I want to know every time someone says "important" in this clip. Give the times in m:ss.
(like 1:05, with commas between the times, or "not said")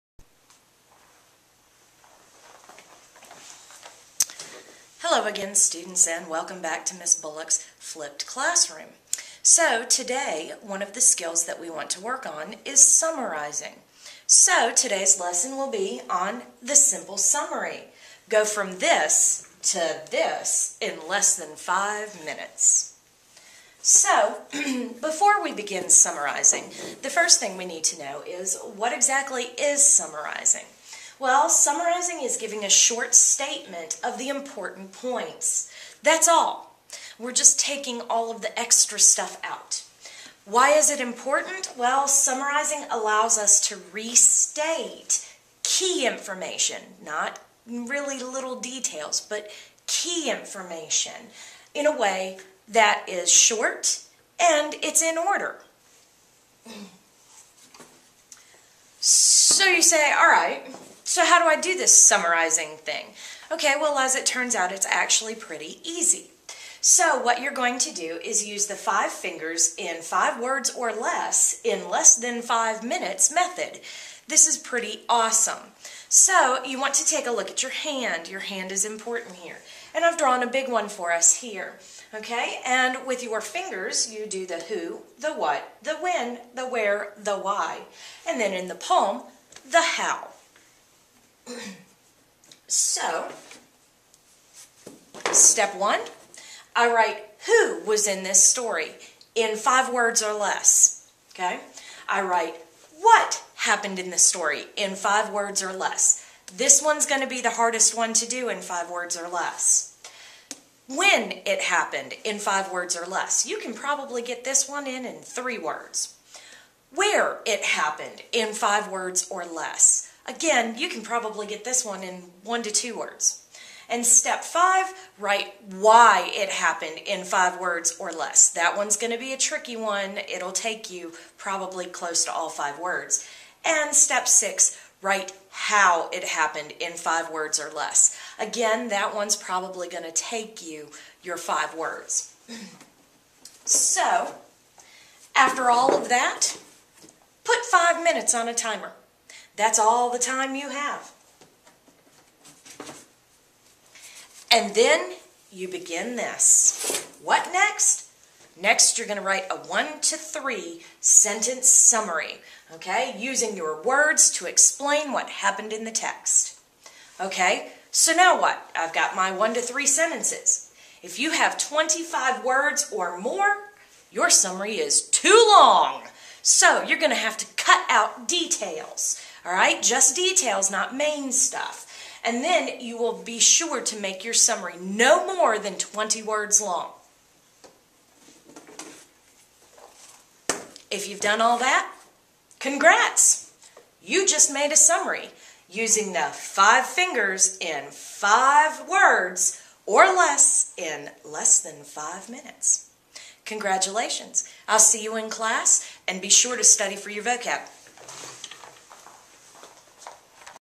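0:34, 0:40, 1:18.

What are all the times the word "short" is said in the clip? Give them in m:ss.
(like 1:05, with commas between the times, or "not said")
0:32, 0:53.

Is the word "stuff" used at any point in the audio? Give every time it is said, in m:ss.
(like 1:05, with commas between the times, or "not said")
0:38, 3:01.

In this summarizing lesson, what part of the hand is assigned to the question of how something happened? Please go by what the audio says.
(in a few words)
the palm.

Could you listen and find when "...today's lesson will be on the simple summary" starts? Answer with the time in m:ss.
0:14.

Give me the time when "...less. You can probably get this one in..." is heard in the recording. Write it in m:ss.
1:53.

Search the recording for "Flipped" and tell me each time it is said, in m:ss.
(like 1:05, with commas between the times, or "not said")
0:07.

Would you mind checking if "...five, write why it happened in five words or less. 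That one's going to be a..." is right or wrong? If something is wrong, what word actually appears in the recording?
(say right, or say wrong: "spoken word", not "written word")
right.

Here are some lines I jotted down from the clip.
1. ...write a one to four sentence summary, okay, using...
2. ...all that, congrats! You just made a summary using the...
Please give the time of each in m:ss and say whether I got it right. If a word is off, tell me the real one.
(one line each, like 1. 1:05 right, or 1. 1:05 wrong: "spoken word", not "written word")
1. 2:39 wrong: "three", not "four"
2. 3:11 right.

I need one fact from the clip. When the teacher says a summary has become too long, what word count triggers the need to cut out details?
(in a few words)
25 words or more.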